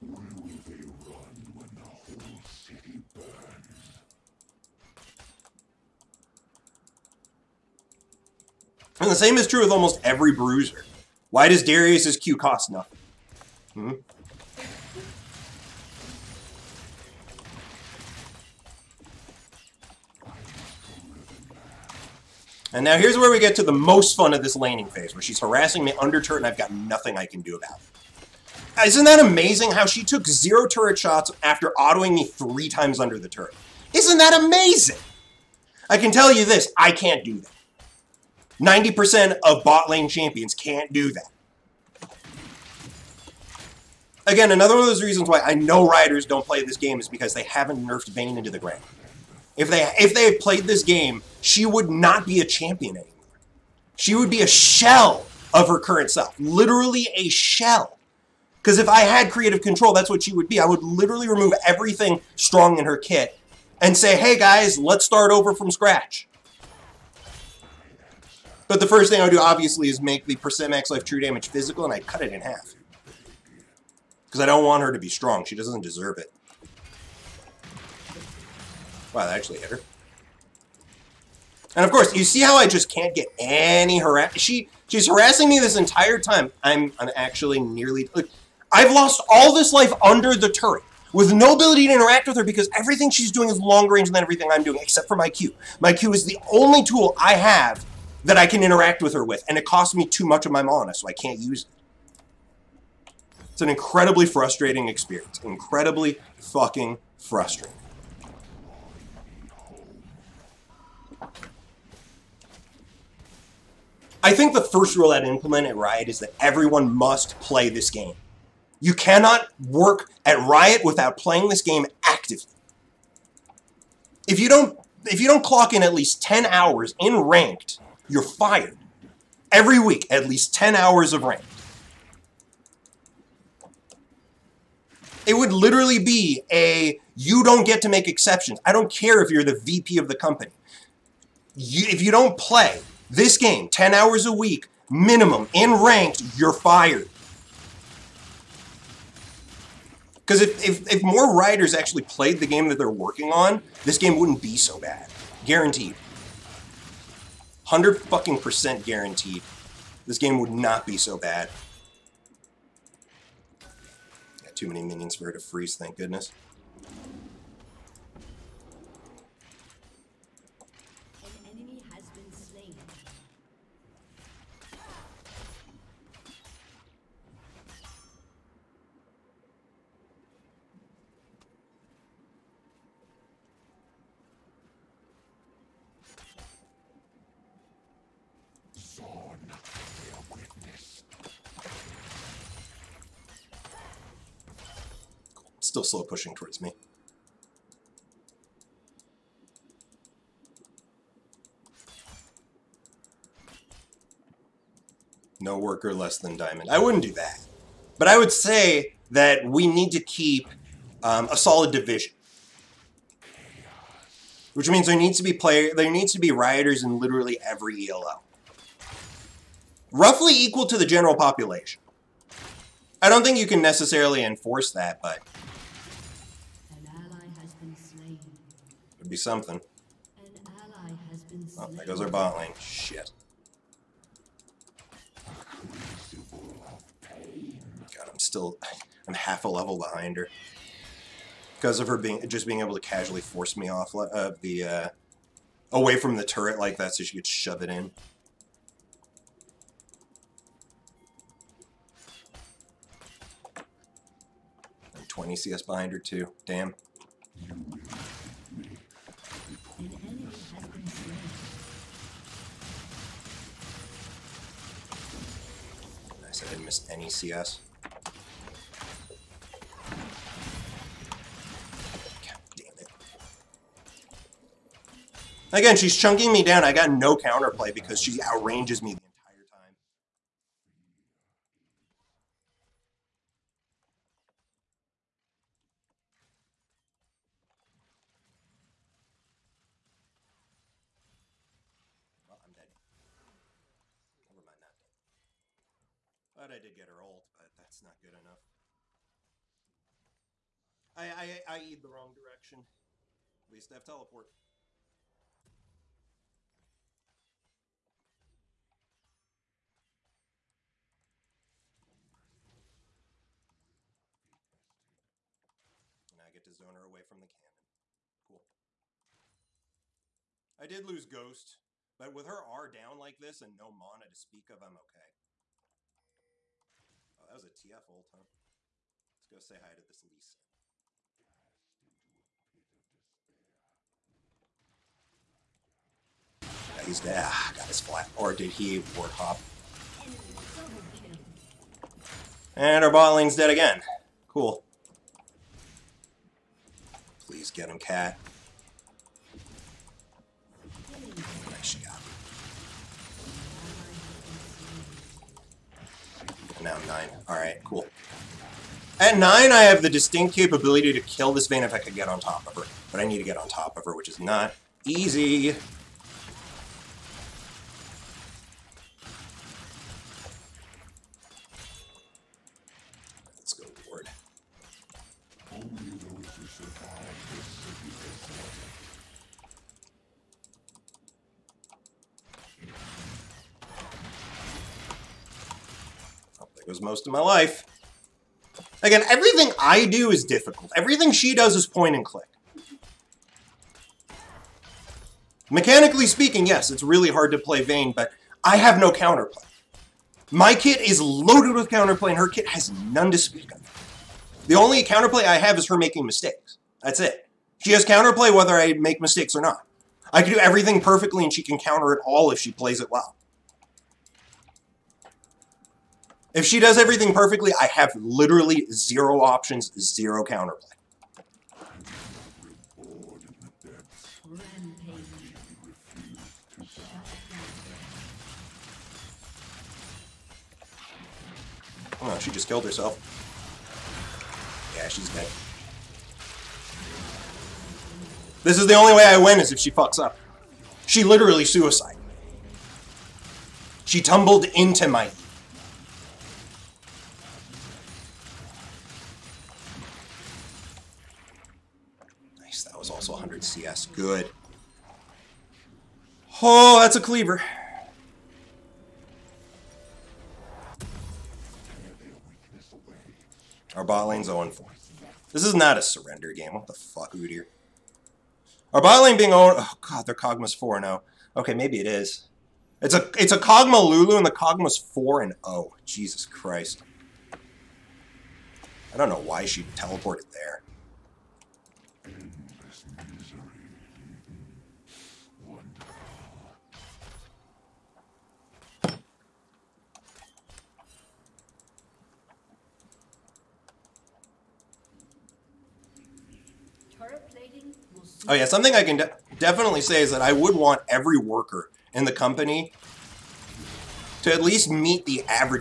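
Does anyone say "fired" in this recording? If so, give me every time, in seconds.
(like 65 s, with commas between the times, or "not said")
128 s, 146 s.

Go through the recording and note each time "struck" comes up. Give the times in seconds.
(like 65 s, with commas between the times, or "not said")
not said.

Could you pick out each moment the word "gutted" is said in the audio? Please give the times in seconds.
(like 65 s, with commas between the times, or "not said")
not said.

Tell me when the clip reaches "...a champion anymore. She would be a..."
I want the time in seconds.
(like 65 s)
52 s.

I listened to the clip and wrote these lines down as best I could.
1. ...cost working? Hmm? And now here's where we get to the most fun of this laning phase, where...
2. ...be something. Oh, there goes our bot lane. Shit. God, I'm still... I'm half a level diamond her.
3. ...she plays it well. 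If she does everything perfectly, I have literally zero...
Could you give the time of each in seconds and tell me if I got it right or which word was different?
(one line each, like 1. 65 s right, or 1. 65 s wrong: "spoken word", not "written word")
1. 12 s wrong: "nothing", not "working"
2. 229 s wrong: "behind", not "diamond"
3. 412 s right.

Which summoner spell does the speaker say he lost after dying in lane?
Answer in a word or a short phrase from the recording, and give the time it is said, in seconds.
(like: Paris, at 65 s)
Ghost, at 321 s.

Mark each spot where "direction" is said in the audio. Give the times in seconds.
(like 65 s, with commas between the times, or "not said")
302 s.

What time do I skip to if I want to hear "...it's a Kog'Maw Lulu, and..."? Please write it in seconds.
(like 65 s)
473 s.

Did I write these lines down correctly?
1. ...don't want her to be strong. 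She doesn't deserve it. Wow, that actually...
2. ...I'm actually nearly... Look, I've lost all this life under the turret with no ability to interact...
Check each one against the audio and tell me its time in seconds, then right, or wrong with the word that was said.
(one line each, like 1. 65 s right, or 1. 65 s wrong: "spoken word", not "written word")
1. 74 s right
2. 86 s right.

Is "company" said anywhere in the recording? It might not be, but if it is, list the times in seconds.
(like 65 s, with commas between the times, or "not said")
140 s, 502 s.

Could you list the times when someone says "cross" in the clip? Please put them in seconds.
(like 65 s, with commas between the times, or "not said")
not said.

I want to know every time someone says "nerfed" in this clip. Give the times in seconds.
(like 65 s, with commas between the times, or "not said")
47 s.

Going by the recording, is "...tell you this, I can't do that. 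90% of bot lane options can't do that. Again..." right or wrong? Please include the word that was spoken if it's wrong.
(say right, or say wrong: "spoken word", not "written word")
wrong: "champions", not "options".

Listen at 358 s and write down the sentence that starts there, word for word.
At 9, I have the distinct capability to kill this Vayne if I could get on top of her.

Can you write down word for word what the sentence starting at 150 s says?
Because if, if, if more Rioters actually played the game that they're working on, this game wouldn't be so bad.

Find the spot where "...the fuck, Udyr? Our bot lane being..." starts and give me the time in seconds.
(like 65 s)
466 s.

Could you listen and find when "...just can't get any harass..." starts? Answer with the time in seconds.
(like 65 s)
82 s.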